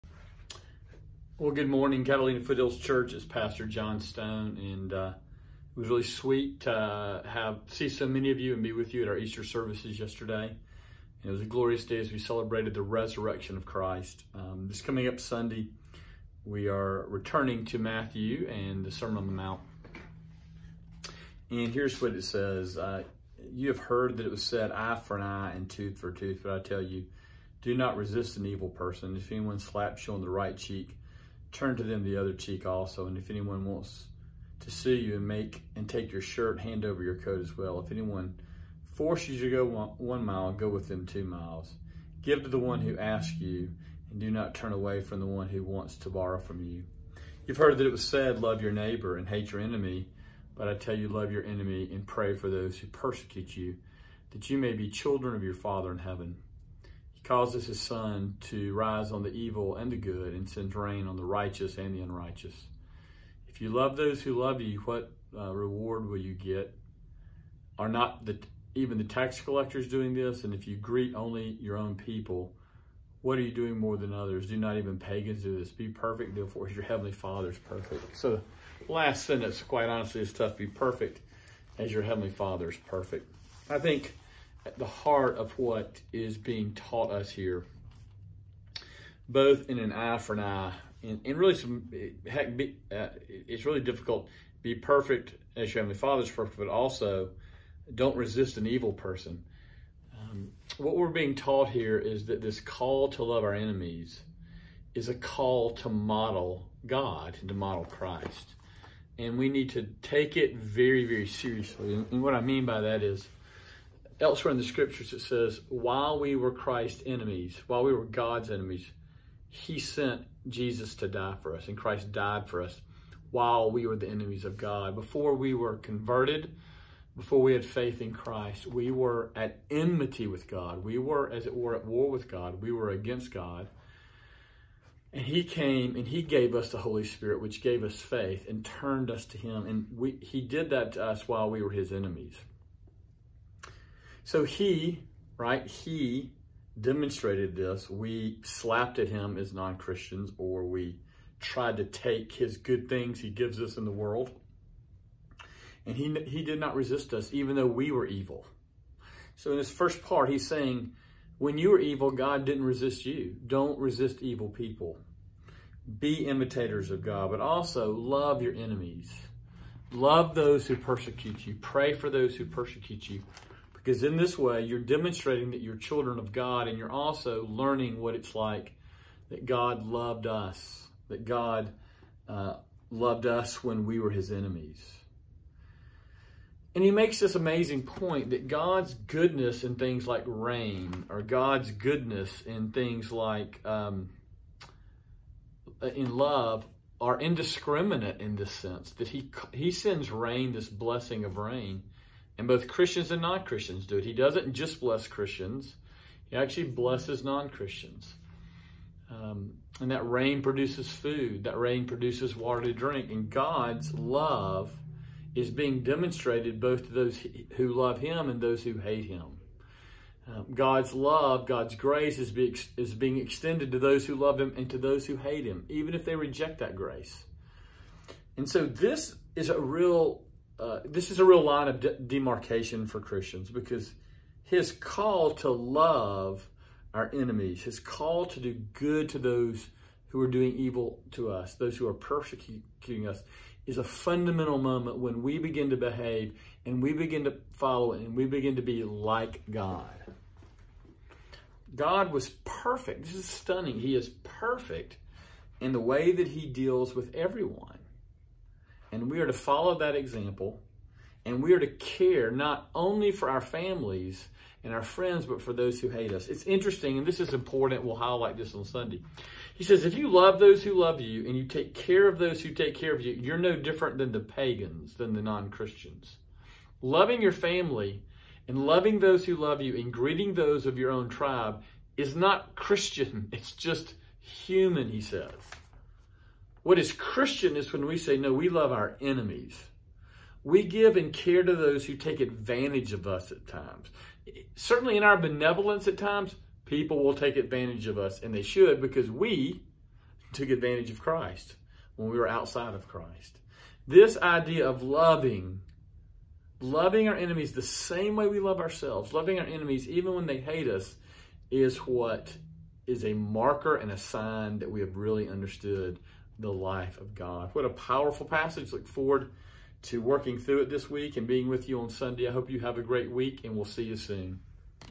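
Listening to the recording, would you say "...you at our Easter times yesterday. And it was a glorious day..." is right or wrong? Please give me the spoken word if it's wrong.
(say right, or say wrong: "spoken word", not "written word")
wrong: "services", not "times".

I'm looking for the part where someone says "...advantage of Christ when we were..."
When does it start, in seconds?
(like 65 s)
300 s.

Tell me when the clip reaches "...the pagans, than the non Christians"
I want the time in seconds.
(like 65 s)
274 s.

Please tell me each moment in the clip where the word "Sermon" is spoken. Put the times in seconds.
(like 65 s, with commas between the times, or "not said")
18 s.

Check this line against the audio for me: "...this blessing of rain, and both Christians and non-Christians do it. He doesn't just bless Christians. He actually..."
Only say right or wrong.
right.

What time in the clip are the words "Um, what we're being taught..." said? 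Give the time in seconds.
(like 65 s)
100 s.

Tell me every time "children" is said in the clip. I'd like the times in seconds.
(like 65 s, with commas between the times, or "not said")
54 s, 175 s.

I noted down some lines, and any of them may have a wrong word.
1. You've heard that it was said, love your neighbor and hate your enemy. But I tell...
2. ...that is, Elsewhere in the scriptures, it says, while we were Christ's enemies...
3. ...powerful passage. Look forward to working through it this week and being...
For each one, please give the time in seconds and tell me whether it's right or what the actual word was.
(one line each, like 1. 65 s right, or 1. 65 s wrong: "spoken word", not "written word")
1. 47 s right
2. 112 s right
3. 317 s right.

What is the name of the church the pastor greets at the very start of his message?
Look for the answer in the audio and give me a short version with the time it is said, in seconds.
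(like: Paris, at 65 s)
Catalina Foothills Church, at 2 s.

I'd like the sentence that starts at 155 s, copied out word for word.
And he, he did not resist us, even though we were evil.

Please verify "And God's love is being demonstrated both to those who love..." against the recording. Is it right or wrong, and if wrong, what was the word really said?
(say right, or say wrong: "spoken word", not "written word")
right.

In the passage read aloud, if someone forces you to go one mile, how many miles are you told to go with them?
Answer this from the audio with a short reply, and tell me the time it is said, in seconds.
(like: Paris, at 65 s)
2, at 41 s.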